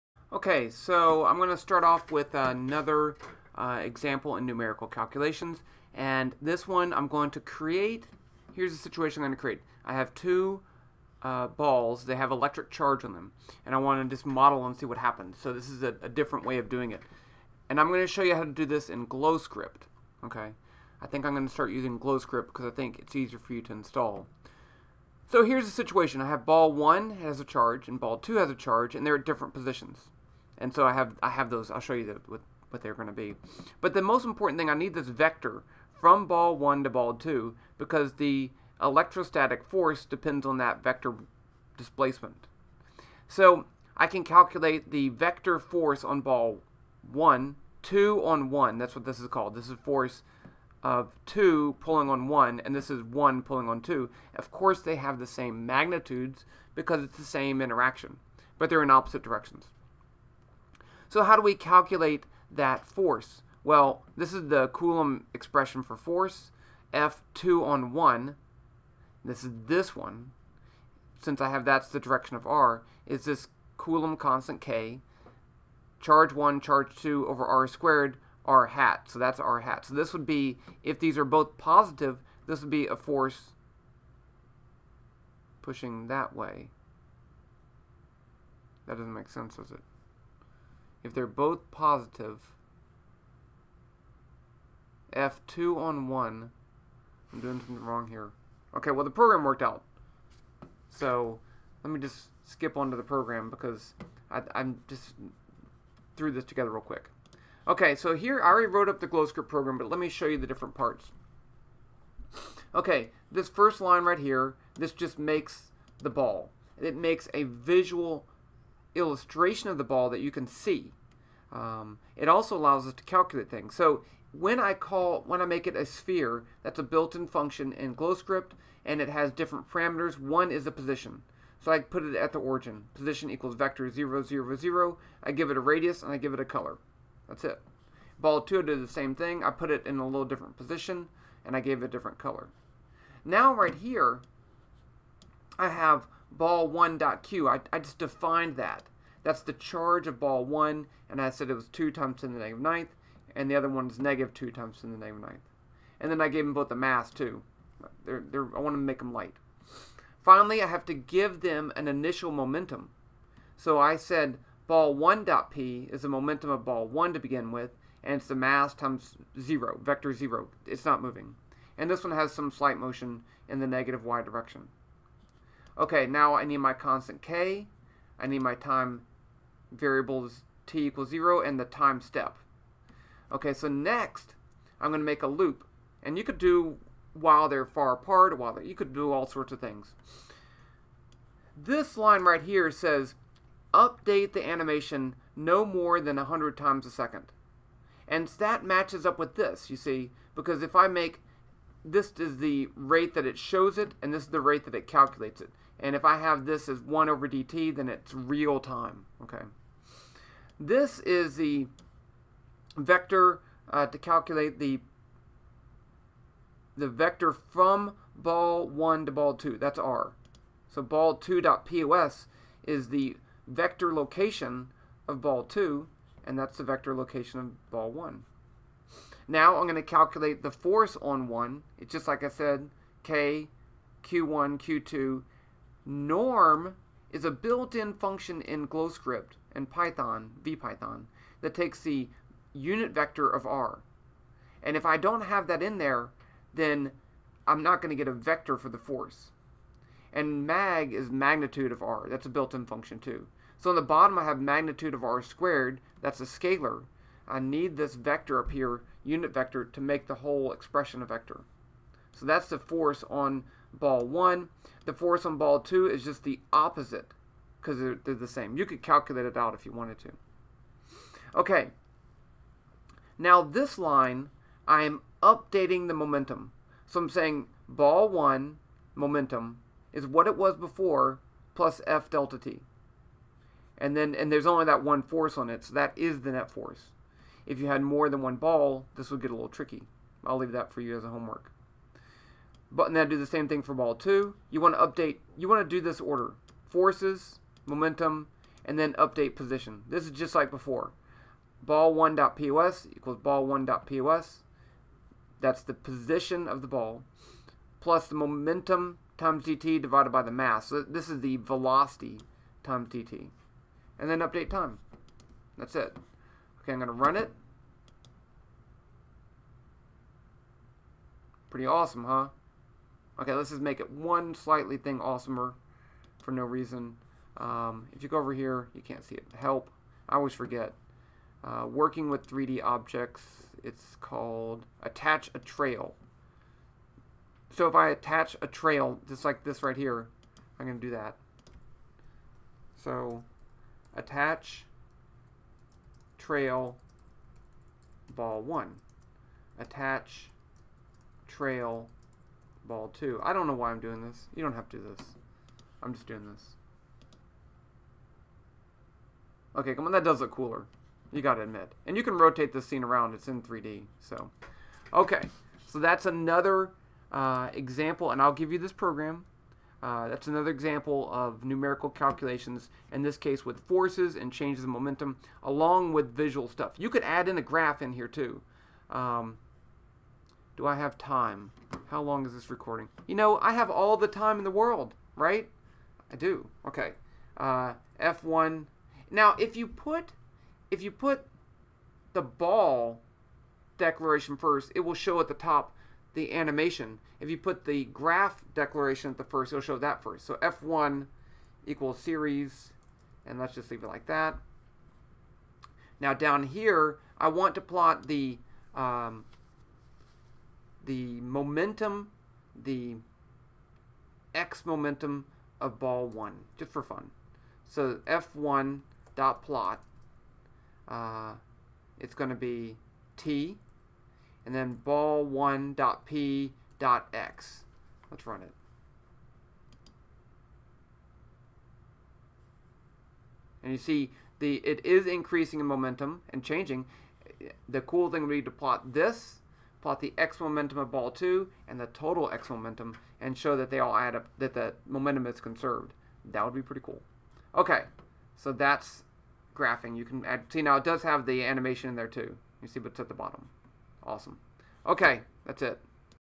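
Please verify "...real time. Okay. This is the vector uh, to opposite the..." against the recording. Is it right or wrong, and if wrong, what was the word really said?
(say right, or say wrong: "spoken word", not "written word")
wrong: "calculate", not "opposite".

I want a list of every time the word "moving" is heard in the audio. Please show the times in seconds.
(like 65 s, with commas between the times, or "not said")
171 s.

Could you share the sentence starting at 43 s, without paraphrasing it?
So I can calculate the vector force on ball one, two on one.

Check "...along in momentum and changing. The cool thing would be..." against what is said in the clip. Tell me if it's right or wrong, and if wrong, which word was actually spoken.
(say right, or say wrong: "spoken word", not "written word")
wrong: "increasing", not "along".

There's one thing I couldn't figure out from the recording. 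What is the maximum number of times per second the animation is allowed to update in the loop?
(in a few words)
100.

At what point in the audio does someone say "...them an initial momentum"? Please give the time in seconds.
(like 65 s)
161 s.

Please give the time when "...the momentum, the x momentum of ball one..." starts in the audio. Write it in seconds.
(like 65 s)
410 s.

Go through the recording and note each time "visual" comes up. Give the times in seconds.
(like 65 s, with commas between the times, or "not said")
117 s, 376 s.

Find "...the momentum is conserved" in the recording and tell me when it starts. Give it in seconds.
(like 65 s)
444 s.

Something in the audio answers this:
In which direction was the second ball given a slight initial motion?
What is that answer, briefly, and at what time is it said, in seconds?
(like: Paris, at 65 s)
negative y direction, at 173 s.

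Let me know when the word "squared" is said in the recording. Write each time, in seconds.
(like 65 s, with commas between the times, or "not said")
77 s, 255 s.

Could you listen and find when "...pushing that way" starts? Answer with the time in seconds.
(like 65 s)
85 s.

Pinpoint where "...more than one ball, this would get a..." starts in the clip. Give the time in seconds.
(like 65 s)
287 s.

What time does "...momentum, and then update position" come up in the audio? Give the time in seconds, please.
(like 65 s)
297 s.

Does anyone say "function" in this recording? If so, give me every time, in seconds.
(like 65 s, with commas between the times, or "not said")
127 s, 237 s, 252 s.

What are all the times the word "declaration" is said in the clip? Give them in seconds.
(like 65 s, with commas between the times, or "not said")
393 s, 398 s.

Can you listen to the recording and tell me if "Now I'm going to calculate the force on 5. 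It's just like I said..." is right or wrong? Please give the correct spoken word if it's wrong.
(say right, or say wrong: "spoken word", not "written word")
wrong: "1", not "5".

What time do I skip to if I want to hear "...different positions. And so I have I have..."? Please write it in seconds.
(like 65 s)
29 s.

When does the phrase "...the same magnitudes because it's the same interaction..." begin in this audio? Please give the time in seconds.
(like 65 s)
55 s.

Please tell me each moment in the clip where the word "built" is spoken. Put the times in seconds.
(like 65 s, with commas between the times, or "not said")
126 s, 237 s, 252 s.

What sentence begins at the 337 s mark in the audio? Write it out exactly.
So if I attach a trail, just like this right here, I'm going to do that.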